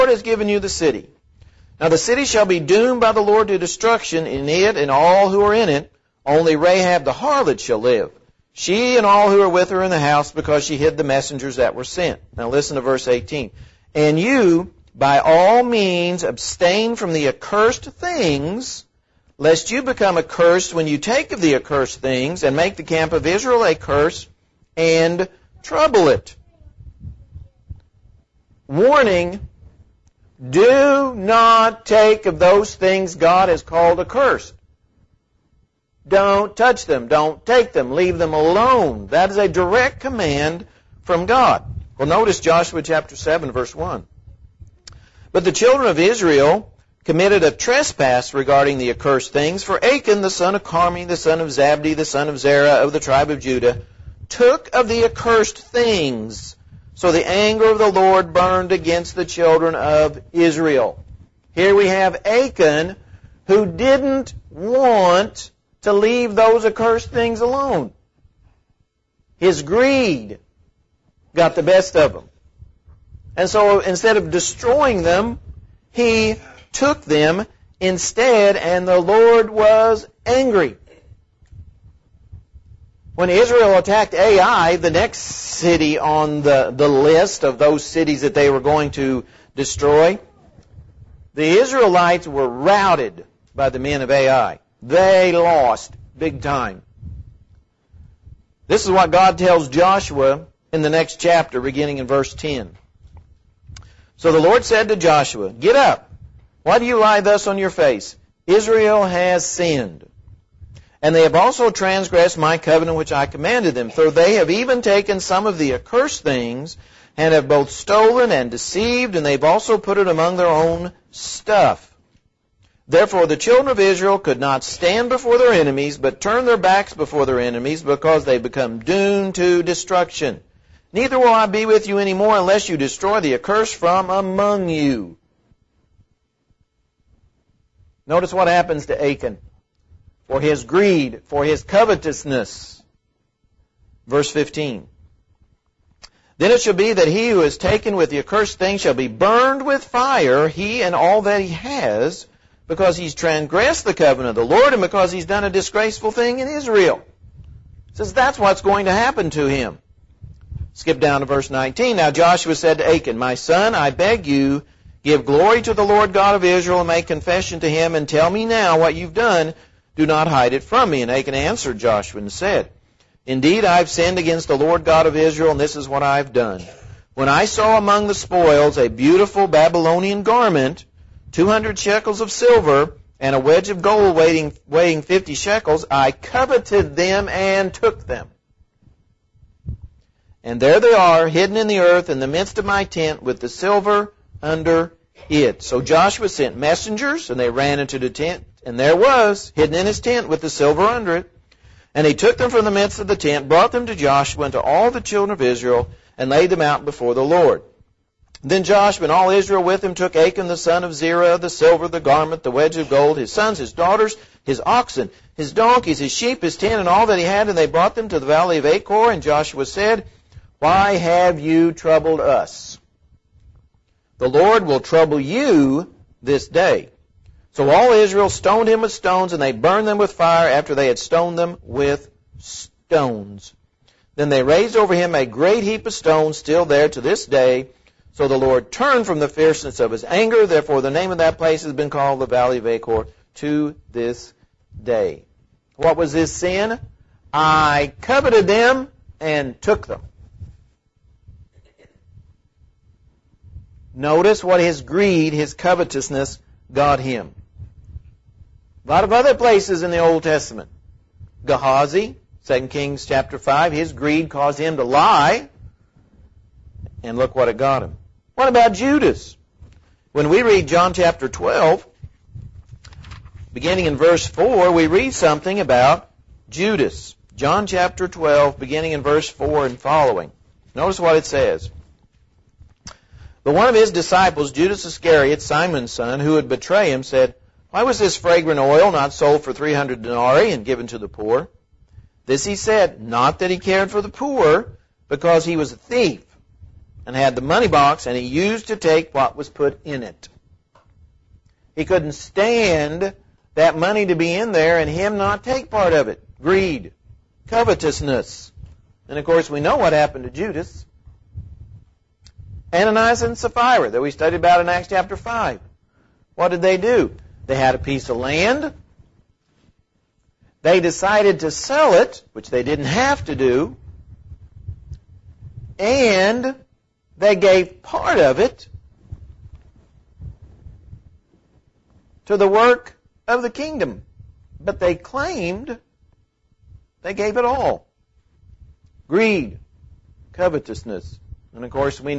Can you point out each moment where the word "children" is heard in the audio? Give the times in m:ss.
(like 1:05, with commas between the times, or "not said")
0:45, 0:59, 2:03, 3:24.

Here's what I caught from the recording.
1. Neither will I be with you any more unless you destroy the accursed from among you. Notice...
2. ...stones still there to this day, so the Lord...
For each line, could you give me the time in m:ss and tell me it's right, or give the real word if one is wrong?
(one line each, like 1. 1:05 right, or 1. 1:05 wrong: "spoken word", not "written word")
1. 2:10 right
2. 3:55 right.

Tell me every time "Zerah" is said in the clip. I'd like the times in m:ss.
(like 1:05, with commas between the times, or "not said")
0:52, 3:30.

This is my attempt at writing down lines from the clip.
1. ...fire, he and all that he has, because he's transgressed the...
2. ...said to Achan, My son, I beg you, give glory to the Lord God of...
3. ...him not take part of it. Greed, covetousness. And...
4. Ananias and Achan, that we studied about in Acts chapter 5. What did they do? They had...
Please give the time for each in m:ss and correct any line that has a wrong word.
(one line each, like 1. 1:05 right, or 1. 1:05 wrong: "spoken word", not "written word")
1. 2:29 right
2. 2:42 right
3. 5:04 right
4. 5:12 wrong: "Sapphira", not "Achan".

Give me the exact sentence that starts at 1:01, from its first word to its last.
Here we have Achan, who didn't want to leave those accursed things alone.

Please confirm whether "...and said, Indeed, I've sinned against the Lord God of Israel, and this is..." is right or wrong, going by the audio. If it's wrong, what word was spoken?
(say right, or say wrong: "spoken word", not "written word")
right.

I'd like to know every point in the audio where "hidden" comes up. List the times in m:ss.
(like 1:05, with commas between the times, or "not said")
3:11, 3:19.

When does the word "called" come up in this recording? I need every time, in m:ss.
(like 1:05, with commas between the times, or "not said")
0:33, 4:01.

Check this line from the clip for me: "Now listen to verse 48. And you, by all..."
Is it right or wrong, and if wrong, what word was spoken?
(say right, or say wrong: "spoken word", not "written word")
wrong: "18", not "48".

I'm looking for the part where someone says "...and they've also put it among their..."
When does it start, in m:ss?
1:59.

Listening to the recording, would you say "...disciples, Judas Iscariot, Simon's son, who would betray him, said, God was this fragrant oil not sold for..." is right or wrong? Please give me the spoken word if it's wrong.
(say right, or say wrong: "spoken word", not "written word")
wrong: "Why", not "God".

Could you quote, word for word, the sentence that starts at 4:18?
A lot of other places in the Old Testament.